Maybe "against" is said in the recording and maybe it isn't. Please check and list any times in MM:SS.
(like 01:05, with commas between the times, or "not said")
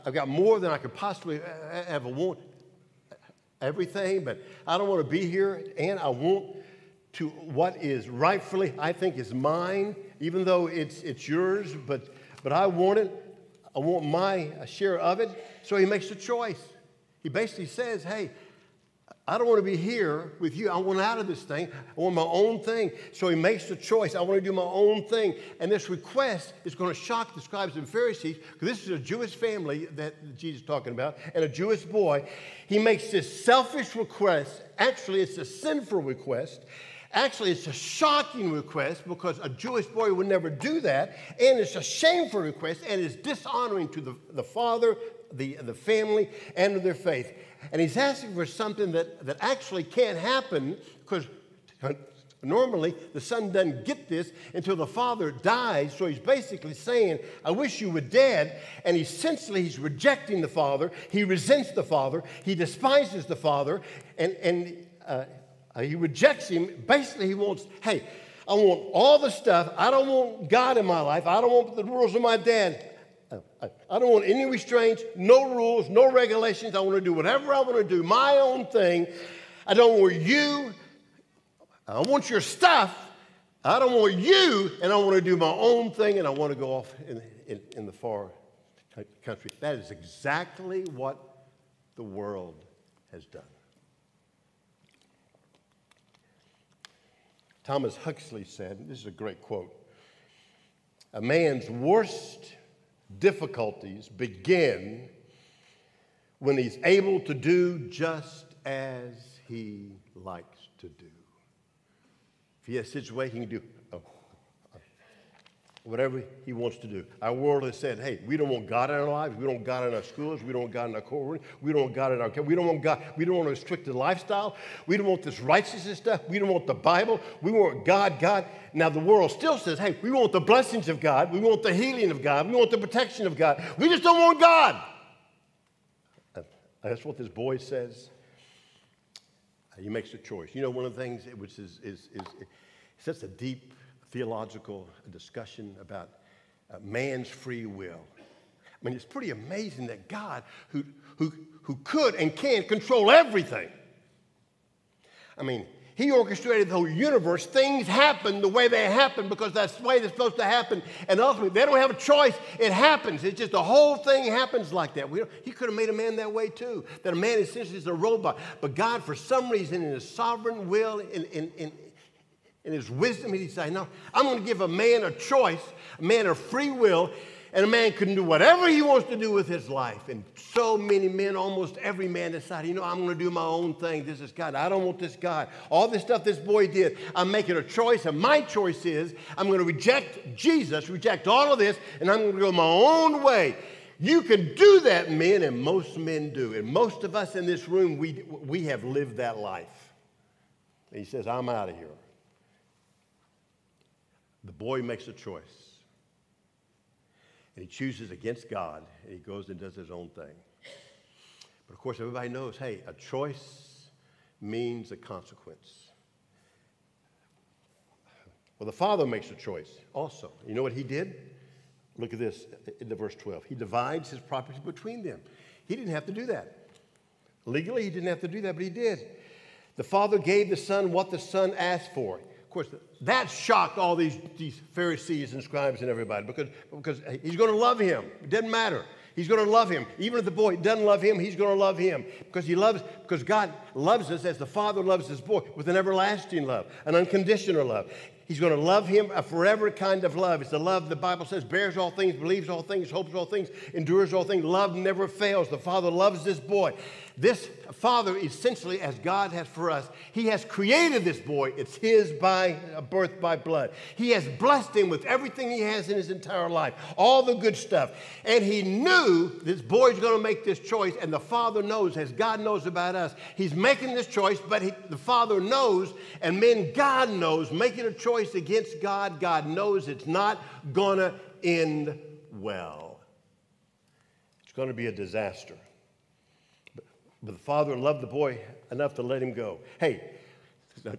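03:28, 04:38.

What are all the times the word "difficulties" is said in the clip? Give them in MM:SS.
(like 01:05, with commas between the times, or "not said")
01:43.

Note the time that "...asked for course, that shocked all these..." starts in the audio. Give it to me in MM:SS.
03:51.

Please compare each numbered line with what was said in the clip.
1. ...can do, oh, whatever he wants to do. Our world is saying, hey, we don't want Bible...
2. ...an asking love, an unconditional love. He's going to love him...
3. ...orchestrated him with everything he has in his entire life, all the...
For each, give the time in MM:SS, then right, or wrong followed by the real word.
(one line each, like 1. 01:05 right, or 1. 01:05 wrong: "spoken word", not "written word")
1. 01:53 wrong: "God", not "Bible"
2. 04:05 wrong: "everlasting", not "asking"
3. 04:24 wrong: "blessed", not "orchestrated".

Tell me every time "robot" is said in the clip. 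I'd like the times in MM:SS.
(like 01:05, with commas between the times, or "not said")
02:47.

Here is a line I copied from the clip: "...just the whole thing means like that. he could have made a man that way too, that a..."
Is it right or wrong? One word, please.
wrong.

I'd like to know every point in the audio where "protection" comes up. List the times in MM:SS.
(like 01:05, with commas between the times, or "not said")
02:12.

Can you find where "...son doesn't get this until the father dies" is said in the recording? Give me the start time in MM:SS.
00:53.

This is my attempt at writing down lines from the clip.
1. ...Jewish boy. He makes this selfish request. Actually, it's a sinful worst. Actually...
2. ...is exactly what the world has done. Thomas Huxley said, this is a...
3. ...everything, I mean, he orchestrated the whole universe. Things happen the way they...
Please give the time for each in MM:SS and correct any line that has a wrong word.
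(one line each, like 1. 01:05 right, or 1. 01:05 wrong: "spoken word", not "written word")
1. 00:31 wrong: "request", not "worst"
2. 01:29 right
3. 02:33 right.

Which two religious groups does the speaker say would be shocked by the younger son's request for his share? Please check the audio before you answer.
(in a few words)
Scribes and Pharisees.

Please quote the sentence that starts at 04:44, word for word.
It's going to be a disaster.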